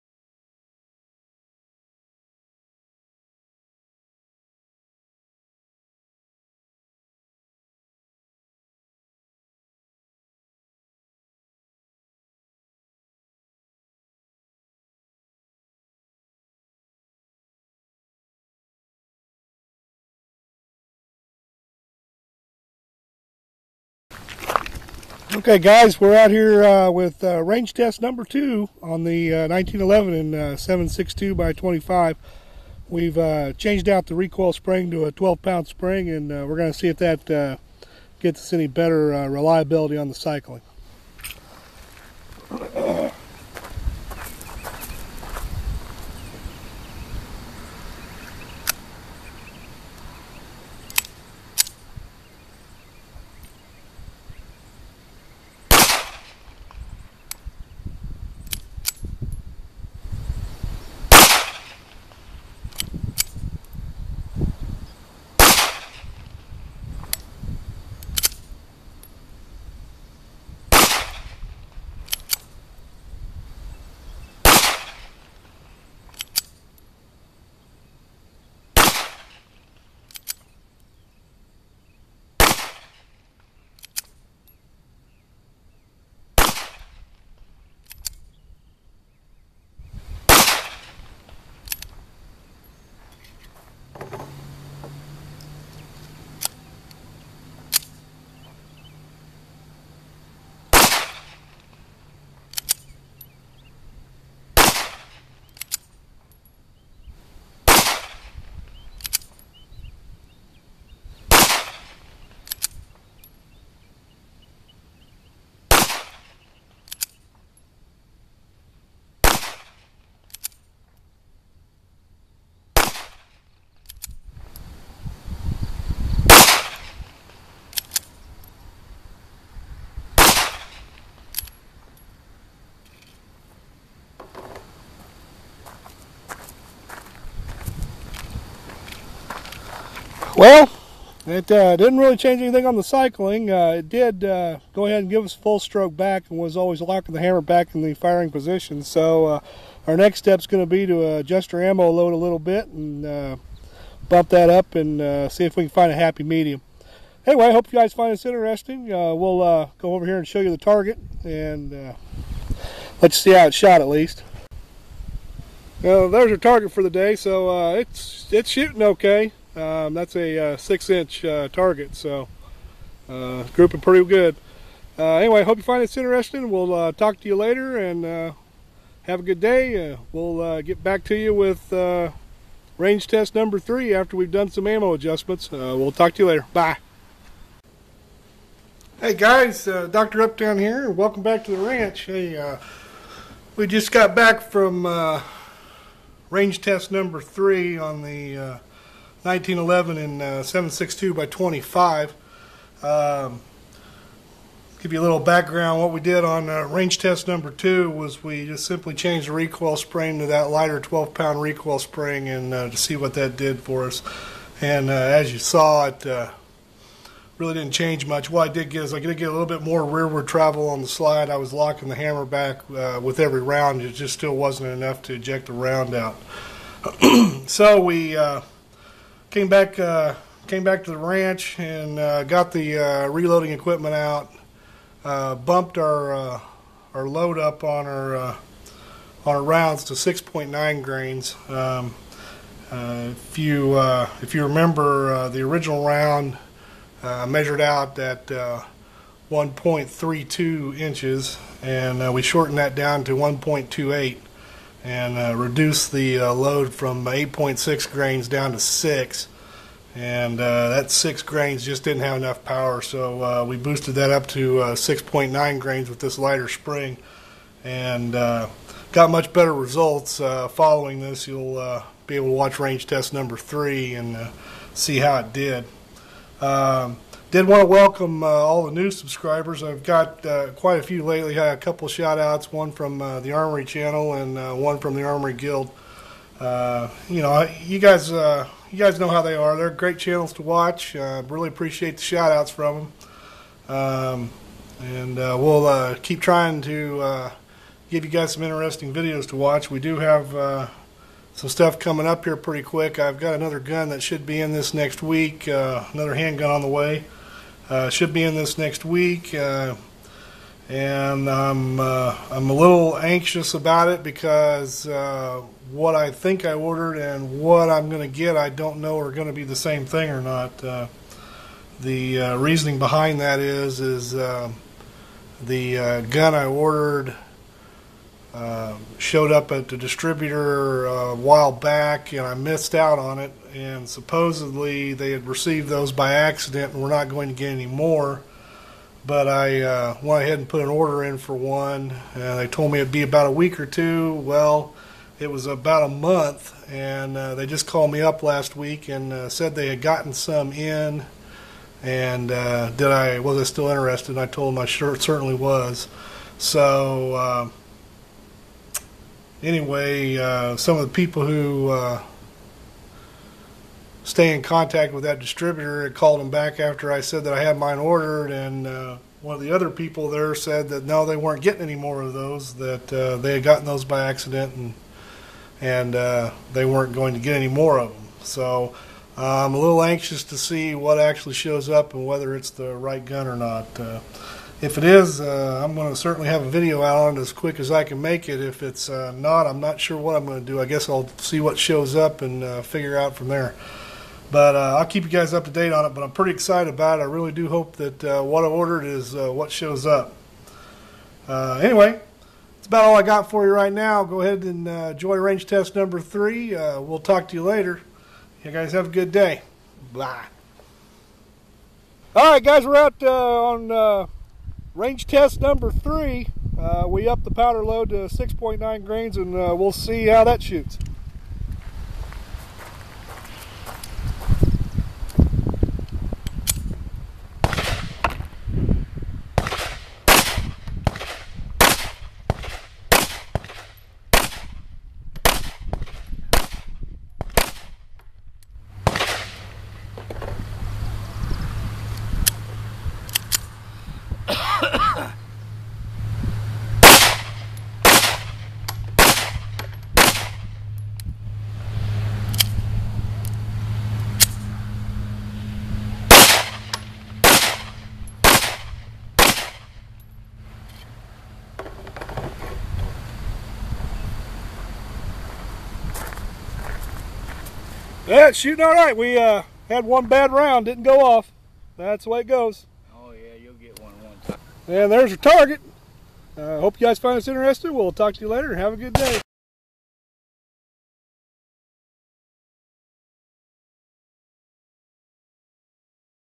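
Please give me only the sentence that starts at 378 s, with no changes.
So I'm a little anxious to see what actually shows up and whether it's the right gun or not.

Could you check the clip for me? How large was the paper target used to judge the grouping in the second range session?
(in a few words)
6 inch.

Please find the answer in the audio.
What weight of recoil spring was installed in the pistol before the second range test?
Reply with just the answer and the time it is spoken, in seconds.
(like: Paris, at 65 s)
12-pound, at 35 s.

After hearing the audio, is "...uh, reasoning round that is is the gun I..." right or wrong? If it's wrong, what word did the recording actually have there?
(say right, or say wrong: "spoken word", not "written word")
wrong: "behind", not "round".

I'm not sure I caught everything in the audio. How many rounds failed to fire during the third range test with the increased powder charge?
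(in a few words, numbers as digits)
1.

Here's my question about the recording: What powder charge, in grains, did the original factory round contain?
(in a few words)
8.6 grains.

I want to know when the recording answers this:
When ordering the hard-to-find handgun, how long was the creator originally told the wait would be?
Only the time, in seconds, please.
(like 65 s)
343 s.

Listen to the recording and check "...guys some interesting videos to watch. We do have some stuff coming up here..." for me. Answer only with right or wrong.
right.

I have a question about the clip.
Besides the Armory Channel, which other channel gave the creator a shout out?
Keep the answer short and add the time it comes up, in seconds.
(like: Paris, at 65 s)
the Armory Guild, at 284 s.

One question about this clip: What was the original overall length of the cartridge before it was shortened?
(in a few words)
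1.32 inches.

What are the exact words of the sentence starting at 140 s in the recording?
Well, it uh, didn't really change anything on the cycling.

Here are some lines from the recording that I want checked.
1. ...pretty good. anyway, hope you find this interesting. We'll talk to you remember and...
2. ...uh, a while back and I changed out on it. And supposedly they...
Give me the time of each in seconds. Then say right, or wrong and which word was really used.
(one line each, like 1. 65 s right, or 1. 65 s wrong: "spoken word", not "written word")
1. 173 s wrong: "later", not "remember"
2. 330 s wrong: "missed", not "changed".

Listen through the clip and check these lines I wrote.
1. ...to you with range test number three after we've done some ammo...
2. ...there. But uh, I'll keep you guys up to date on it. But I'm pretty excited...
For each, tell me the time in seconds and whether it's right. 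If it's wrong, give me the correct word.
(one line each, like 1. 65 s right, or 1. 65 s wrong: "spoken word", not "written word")
1. 181 s right
2. 393 s right.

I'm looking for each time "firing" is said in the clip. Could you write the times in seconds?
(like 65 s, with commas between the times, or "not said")
147 s.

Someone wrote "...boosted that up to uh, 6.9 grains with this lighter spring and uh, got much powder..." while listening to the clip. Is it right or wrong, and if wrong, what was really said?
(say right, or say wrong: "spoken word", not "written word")
wrong: "better", not "powder".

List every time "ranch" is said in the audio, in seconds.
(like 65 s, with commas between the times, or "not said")
191 s, 230 s.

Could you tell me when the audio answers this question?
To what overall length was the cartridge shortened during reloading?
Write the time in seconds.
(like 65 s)
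253 s.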